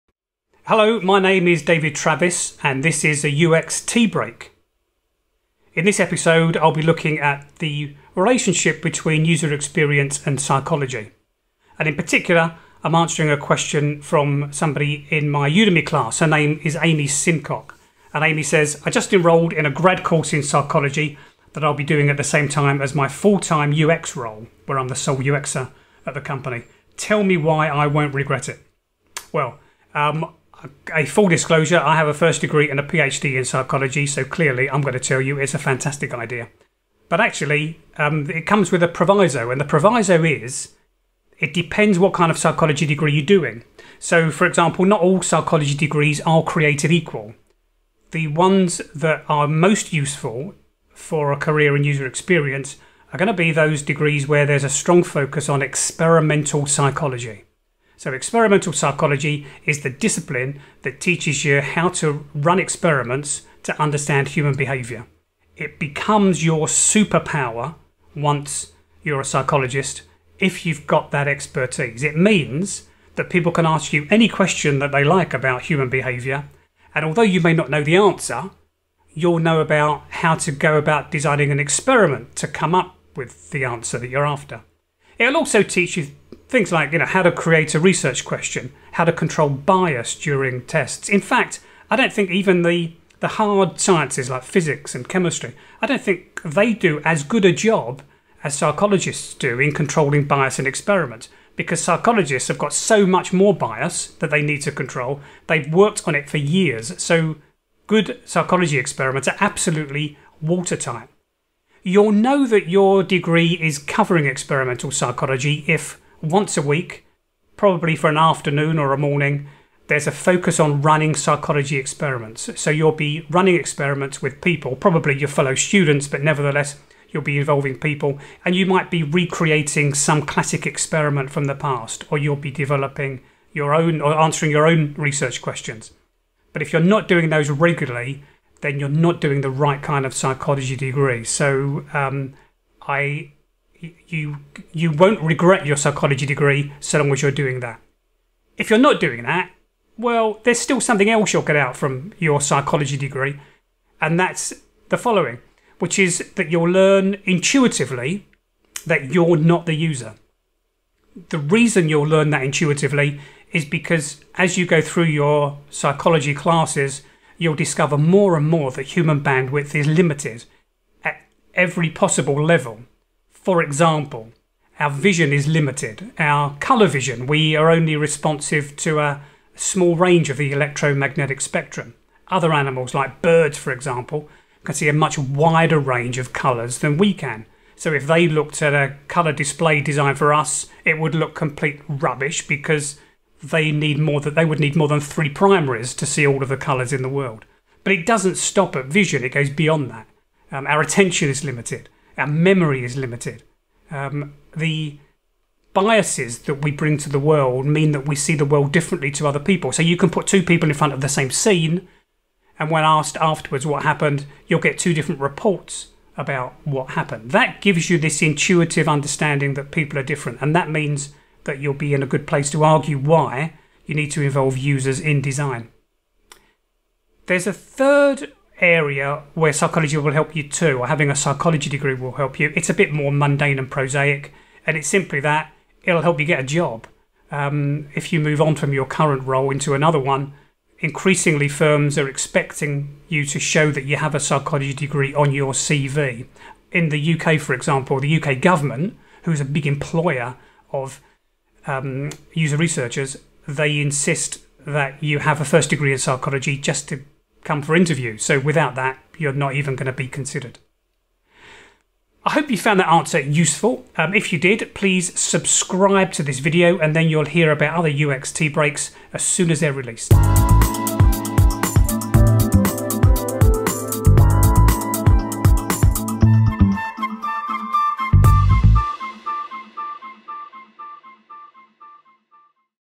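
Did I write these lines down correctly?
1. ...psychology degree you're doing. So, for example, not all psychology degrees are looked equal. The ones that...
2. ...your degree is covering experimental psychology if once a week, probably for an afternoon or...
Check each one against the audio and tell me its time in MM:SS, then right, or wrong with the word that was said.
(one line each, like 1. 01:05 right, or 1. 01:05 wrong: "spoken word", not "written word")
1. 00:42 wrong: "created", not "looked"
2. 01:52 right.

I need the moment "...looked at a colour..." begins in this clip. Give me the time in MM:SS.
03:08.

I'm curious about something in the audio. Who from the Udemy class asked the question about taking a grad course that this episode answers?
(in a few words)
Amy Simcock.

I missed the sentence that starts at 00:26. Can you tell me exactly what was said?
Tell me why I won't regret it.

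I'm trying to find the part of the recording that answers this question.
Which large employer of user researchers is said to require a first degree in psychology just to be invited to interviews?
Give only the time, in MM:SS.
04:08.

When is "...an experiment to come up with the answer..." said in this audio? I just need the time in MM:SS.
01:21.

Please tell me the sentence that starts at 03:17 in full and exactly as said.
But it doesn't stop at vision, it goes beyond that.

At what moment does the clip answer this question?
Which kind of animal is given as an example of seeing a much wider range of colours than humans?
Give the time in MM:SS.
03:03.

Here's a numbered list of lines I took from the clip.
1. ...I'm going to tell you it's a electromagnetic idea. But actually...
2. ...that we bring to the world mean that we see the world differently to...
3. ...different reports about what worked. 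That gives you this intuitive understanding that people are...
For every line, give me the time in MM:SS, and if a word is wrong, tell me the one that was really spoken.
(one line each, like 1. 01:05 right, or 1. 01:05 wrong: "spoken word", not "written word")
1. 00:34 wrong: "fantastic", not "electromagnetic"
2. 03:26 right
3. 03:34 wrong: "happened", not "worked".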